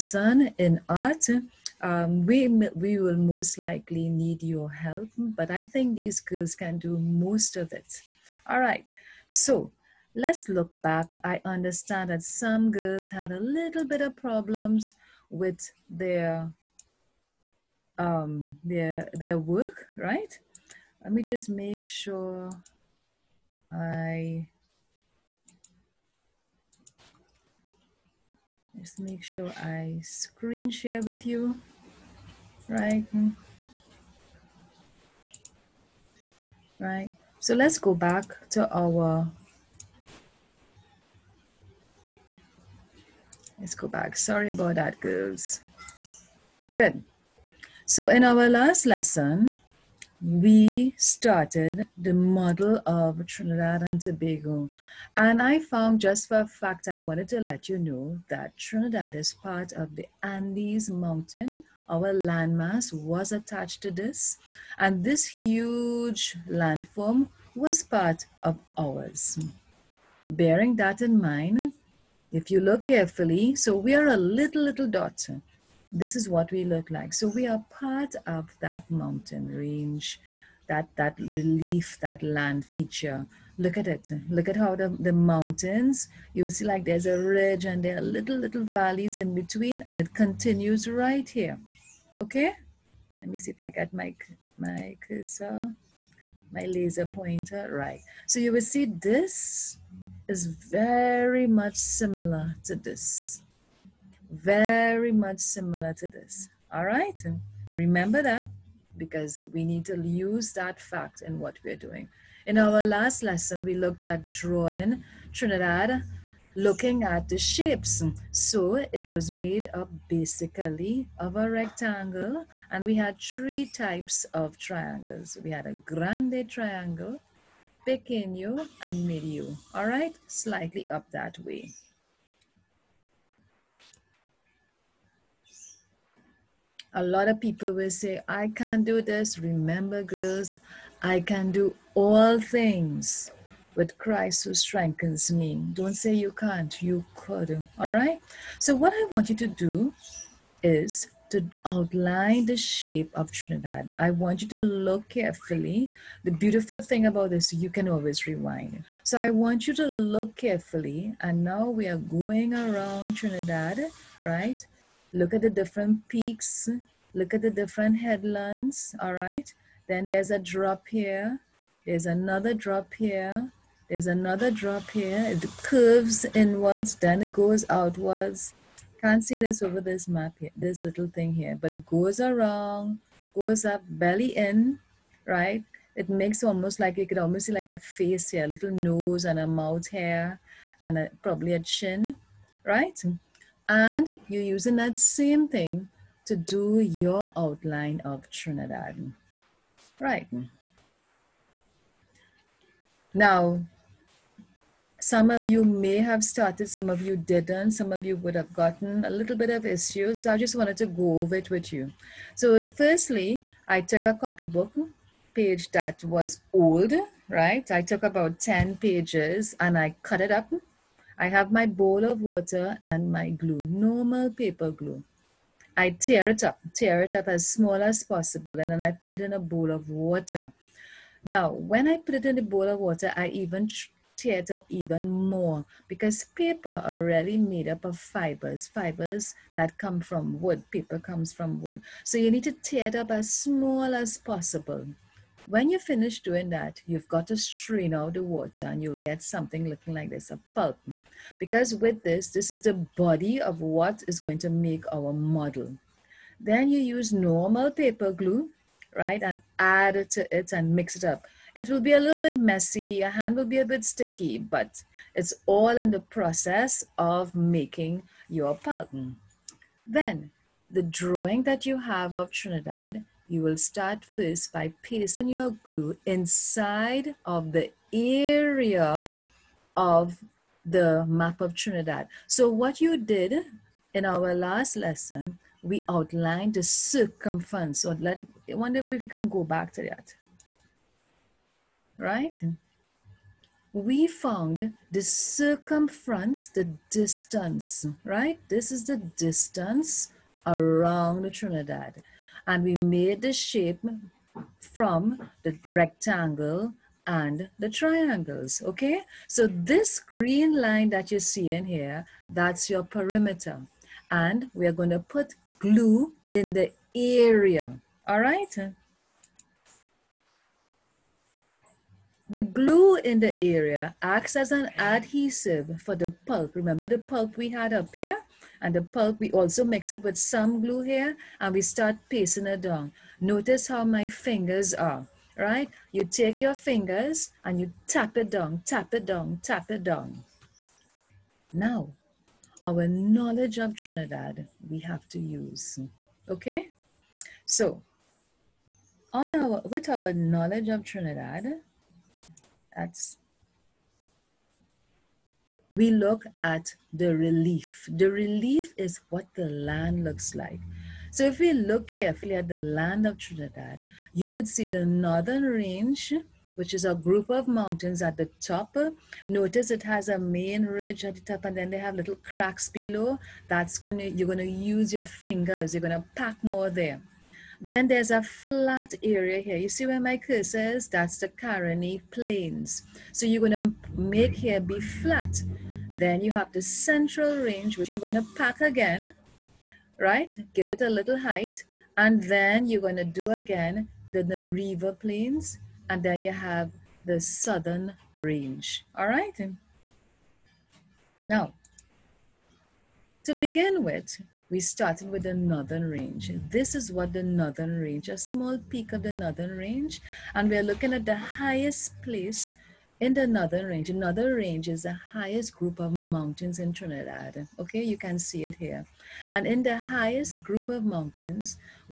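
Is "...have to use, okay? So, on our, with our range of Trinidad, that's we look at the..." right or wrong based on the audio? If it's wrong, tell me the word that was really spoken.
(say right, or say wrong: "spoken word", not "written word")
wrong: "knowledge", not "range".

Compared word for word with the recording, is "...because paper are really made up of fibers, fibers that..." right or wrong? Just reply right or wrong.
right.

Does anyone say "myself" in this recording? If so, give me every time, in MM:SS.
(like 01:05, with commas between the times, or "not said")
not said.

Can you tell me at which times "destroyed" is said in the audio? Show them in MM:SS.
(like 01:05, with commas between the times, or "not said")
not said.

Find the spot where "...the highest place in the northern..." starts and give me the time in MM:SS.
06:51.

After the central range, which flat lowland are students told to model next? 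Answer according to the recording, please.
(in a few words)
Nariva Plains.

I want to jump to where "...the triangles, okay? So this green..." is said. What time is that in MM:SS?
05:07.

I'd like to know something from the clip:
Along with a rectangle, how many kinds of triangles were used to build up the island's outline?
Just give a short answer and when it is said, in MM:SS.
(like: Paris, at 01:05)
3, at 02:03.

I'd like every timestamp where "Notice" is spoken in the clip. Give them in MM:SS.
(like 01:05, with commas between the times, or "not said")
05:33, 06:09.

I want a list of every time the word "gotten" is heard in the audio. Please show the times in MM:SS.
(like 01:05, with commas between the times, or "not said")
03:28.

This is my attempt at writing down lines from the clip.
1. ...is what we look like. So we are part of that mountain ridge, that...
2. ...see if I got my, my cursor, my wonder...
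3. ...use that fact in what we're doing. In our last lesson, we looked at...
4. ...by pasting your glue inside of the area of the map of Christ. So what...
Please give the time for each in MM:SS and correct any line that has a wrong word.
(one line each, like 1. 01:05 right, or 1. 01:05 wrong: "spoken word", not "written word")
1. 01:16 wrong: "range", not "ridge"
2. 01:33 wrong: "laser", not "wonder"
3. 01:50 right
4. 04:34 wrong: "Trinidad", not "Christ".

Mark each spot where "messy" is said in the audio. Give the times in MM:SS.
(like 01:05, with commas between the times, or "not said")
04:22.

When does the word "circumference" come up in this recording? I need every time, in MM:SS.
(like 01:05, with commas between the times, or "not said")
04:46, 04:55.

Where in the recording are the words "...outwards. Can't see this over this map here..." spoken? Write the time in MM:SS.
02:57.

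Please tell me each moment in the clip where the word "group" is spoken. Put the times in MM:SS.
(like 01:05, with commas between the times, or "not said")
06:06, 06:55, 07:00.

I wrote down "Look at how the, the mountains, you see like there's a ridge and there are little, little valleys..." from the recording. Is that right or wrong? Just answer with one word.
right.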